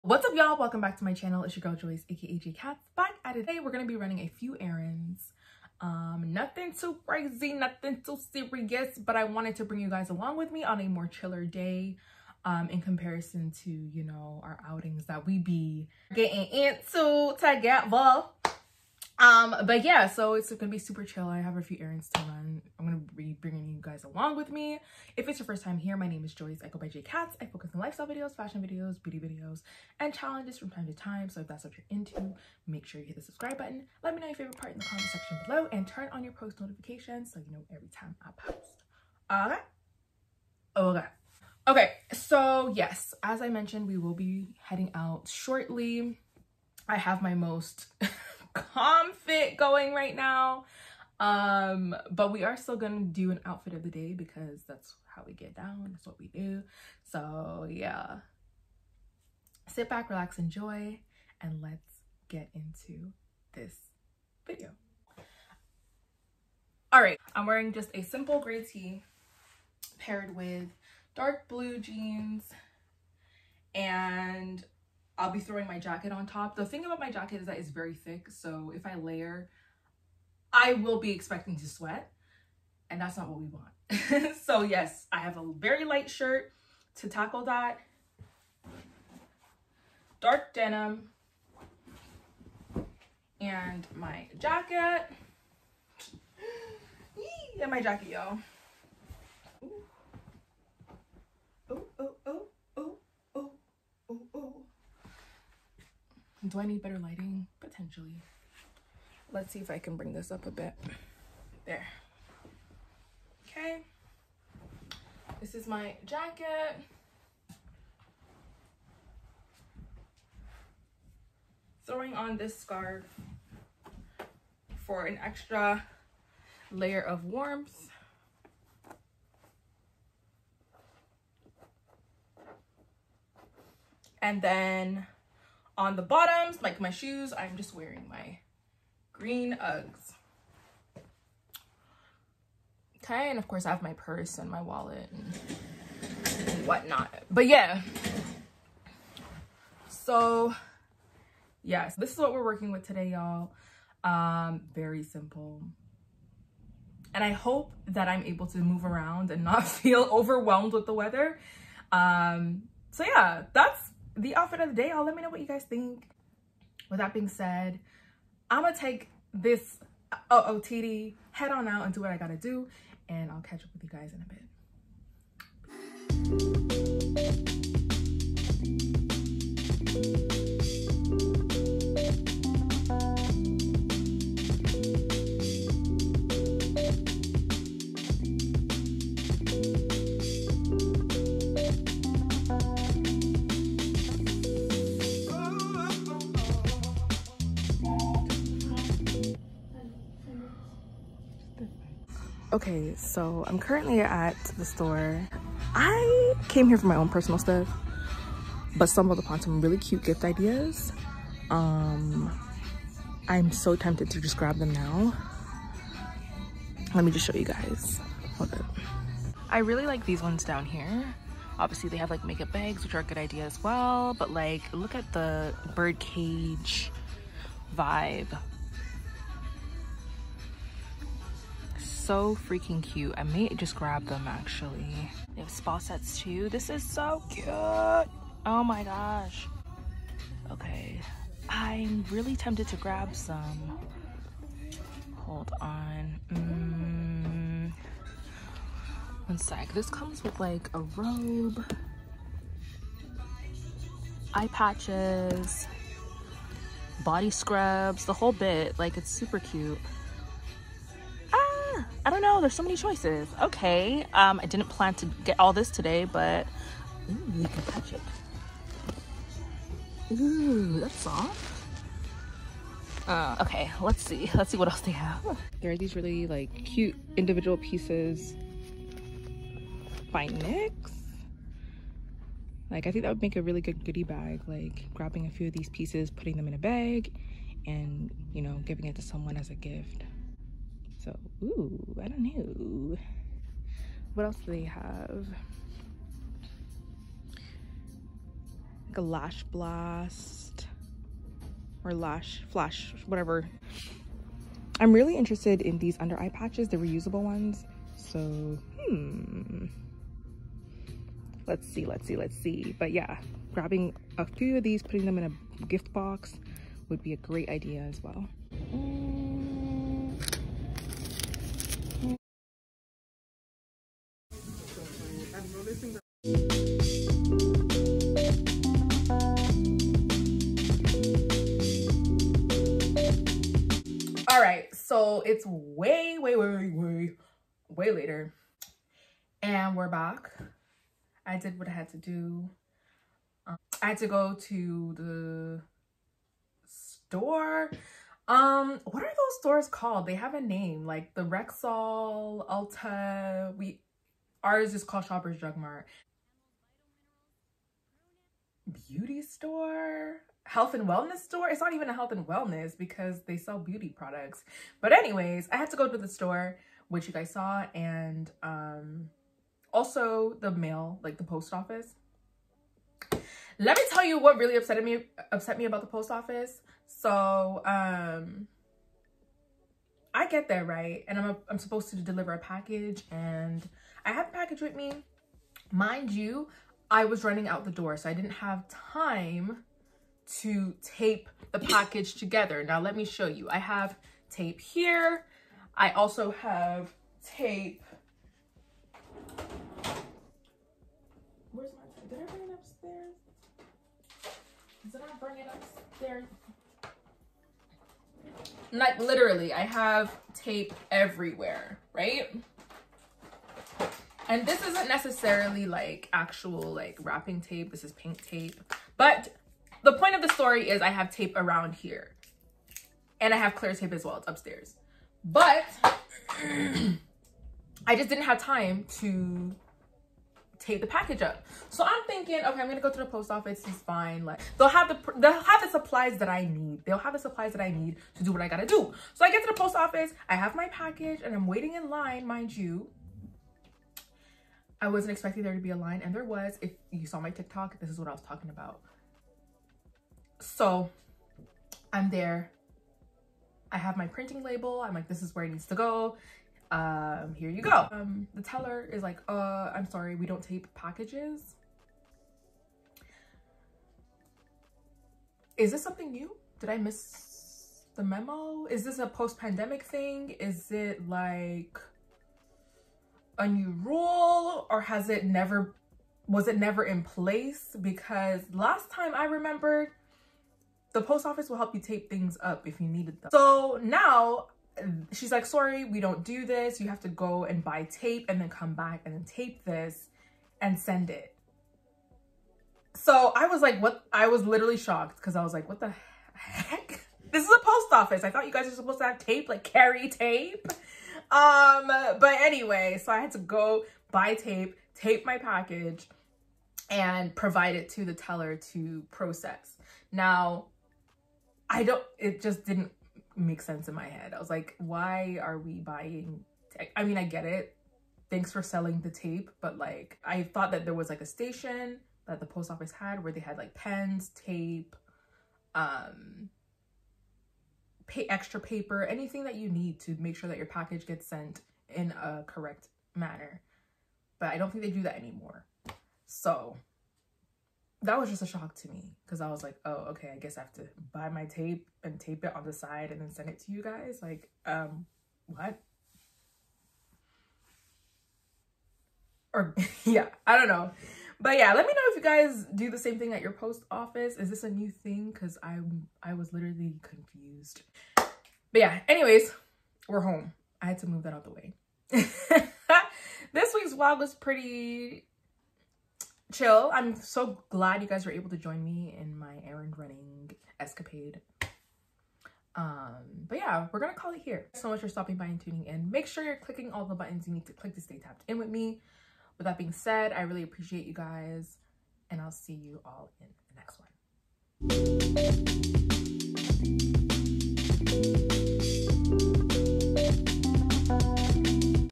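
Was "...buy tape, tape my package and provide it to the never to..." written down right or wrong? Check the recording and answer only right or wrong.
wrong.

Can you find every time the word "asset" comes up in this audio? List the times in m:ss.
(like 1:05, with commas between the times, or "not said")
not said.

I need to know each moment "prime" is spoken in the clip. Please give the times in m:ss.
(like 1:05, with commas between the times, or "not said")
not said.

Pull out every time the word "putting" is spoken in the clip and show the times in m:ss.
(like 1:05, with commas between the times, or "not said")
4:46, 5:14.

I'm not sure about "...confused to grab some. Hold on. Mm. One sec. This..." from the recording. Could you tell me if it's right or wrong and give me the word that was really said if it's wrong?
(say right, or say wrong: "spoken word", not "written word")
wrong: "tempted", not "confused".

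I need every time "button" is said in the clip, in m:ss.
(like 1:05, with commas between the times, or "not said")
0:33, 9:37.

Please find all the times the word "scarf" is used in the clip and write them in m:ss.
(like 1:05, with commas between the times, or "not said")
2:02.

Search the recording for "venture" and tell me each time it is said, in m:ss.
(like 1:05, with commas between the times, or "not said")
not said.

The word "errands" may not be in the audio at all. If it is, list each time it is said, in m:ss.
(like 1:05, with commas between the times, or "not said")
0:04, 0:21, 9:29.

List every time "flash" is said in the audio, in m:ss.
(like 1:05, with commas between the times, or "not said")
5:02.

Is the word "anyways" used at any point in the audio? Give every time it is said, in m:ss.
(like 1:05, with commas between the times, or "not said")
6:04, 8:22, 9:19.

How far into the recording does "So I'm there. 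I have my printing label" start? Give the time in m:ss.
7:30.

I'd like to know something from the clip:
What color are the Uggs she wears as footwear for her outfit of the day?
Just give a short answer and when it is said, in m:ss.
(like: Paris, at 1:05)
Green, at 2:19.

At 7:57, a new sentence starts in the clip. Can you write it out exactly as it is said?
Because last time I remembered, the post office will help you tape things up if you needed them.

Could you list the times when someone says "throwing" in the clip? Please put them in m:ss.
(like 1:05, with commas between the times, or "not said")
1:15, 2:01.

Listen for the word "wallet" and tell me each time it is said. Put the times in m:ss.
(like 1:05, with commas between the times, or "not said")
2:24.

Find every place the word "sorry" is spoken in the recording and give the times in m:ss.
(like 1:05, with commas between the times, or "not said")
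7:39, 8:05.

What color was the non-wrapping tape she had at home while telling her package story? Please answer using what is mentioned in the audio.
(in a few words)
Pink.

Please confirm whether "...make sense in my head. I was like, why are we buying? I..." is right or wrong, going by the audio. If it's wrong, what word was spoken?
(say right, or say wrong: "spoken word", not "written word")
right.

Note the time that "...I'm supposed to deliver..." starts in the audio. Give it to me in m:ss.
6:21.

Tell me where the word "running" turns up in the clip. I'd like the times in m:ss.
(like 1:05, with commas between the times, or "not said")
0:03, 6:27, 9:29.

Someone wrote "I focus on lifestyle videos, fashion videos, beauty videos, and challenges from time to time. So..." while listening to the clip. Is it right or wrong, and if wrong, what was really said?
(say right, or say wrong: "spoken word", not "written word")
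right.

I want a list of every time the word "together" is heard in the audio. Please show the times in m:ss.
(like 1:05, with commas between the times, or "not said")
0:17, 6:32.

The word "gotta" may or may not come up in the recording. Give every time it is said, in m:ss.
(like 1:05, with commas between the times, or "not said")
2:52, 7:18.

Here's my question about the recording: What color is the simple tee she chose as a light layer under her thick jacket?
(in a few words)
Gray.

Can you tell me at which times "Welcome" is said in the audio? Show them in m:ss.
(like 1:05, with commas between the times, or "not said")
0:00.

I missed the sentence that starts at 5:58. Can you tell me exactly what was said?
Beauty store health and wellness store.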